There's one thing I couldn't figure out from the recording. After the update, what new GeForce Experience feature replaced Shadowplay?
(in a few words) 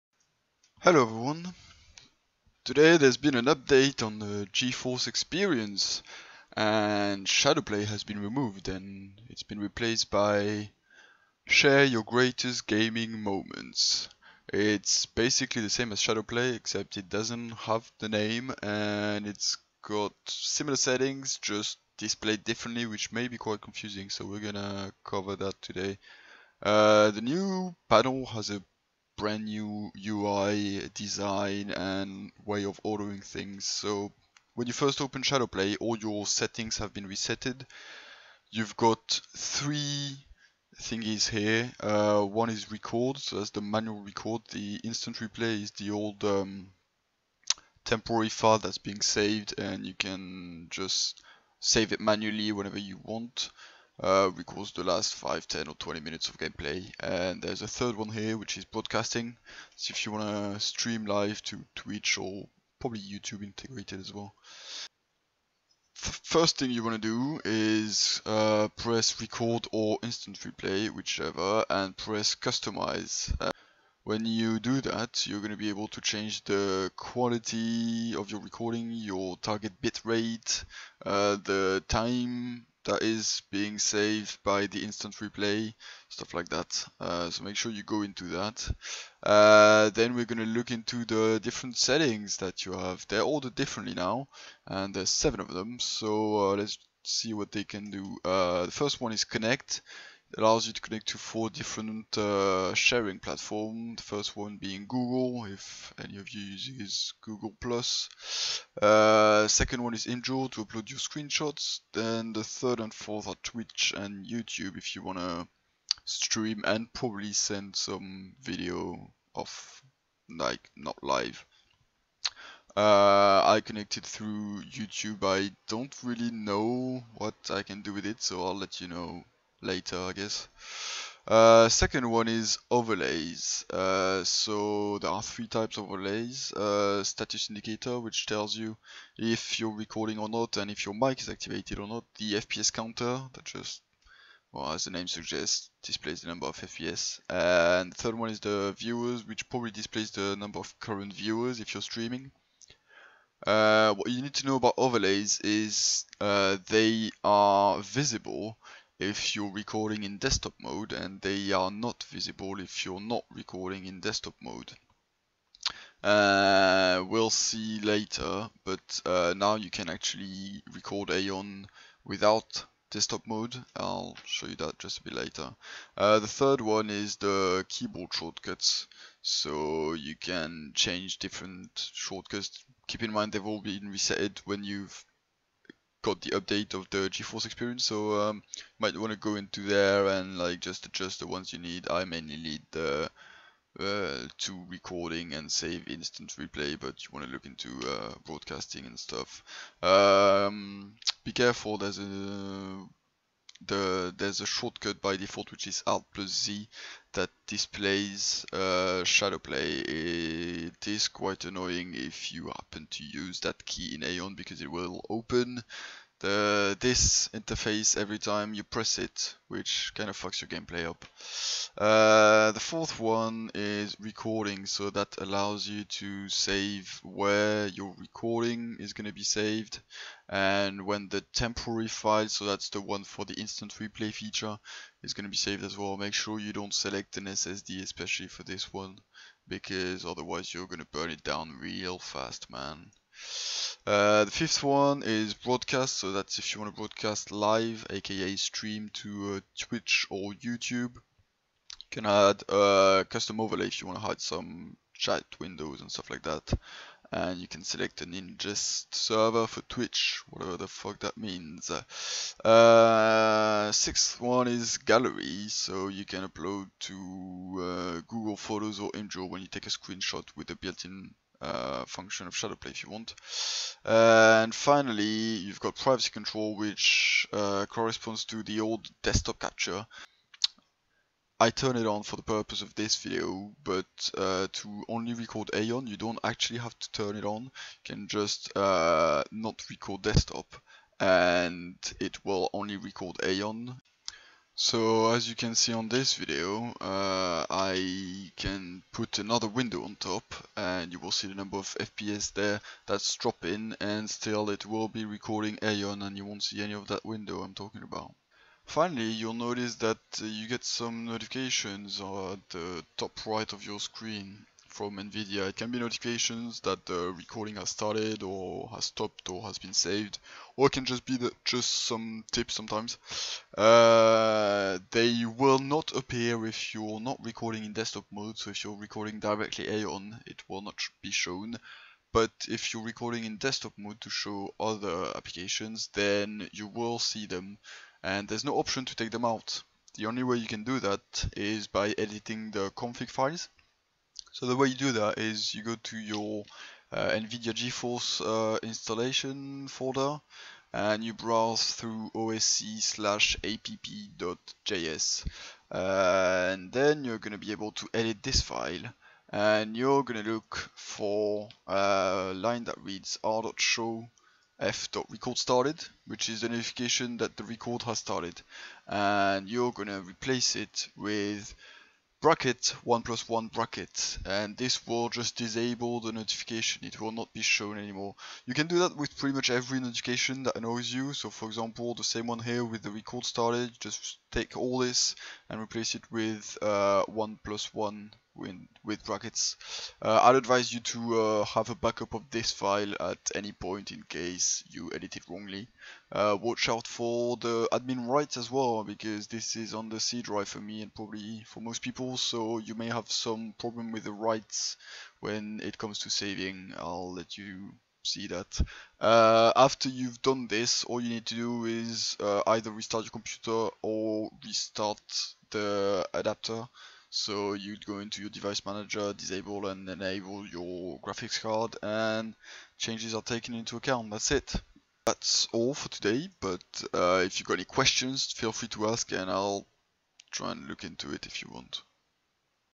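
Share Your Greatest Gaming Moments.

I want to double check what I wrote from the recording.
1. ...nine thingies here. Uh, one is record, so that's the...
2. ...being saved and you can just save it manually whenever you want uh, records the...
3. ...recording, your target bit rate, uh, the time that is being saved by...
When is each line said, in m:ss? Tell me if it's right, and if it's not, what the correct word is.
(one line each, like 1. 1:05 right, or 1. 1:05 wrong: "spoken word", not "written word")
1. 0:39 wrong: "three", not "nine"
2. 0:48 right
3. 1:18 right.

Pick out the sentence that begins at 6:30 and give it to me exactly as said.
Uh, I'd advise you to uh, have a backup of this file at any point in case you edit it wrongly.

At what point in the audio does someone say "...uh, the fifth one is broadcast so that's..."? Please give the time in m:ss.
4:03.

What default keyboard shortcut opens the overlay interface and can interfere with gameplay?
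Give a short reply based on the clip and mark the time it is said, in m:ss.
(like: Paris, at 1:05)
Alt plus Z, at 3:25.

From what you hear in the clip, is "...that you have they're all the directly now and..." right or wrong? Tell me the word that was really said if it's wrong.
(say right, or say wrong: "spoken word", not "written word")
wrong: "differently", not "directly".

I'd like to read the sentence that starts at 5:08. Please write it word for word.
Finally, you'll notice that uh, you get some notifications at the top right of your screen from NVIDIA.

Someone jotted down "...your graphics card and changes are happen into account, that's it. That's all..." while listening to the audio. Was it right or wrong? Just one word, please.
wrong.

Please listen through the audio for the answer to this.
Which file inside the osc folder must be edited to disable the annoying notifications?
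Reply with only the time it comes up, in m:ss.
5:53.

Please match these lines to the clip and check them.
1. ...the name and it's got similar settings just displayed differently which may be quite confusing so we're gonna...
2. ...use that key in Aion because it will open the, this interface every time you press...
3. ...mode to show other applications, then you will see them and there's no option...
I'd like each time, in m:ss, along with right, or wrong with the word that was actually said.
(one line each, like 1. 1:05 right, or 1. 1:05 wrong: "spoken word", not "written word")
1. 0:17 right
2. 3:33 right
3. 5:33 right.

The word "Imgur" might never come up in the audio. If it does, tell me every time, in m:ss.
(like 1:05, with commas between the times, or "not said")
1:50, 4:28.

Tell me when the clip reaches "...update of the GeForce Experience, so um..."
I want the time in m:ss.
3:06.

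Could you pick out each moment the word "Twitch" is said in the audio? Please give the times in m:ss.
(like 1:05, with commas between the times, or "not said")
1:01, 1:53, 4:09, 4:19.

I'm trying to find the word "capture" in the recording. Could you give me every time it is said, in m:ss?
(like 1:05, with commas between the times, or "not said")
4:39.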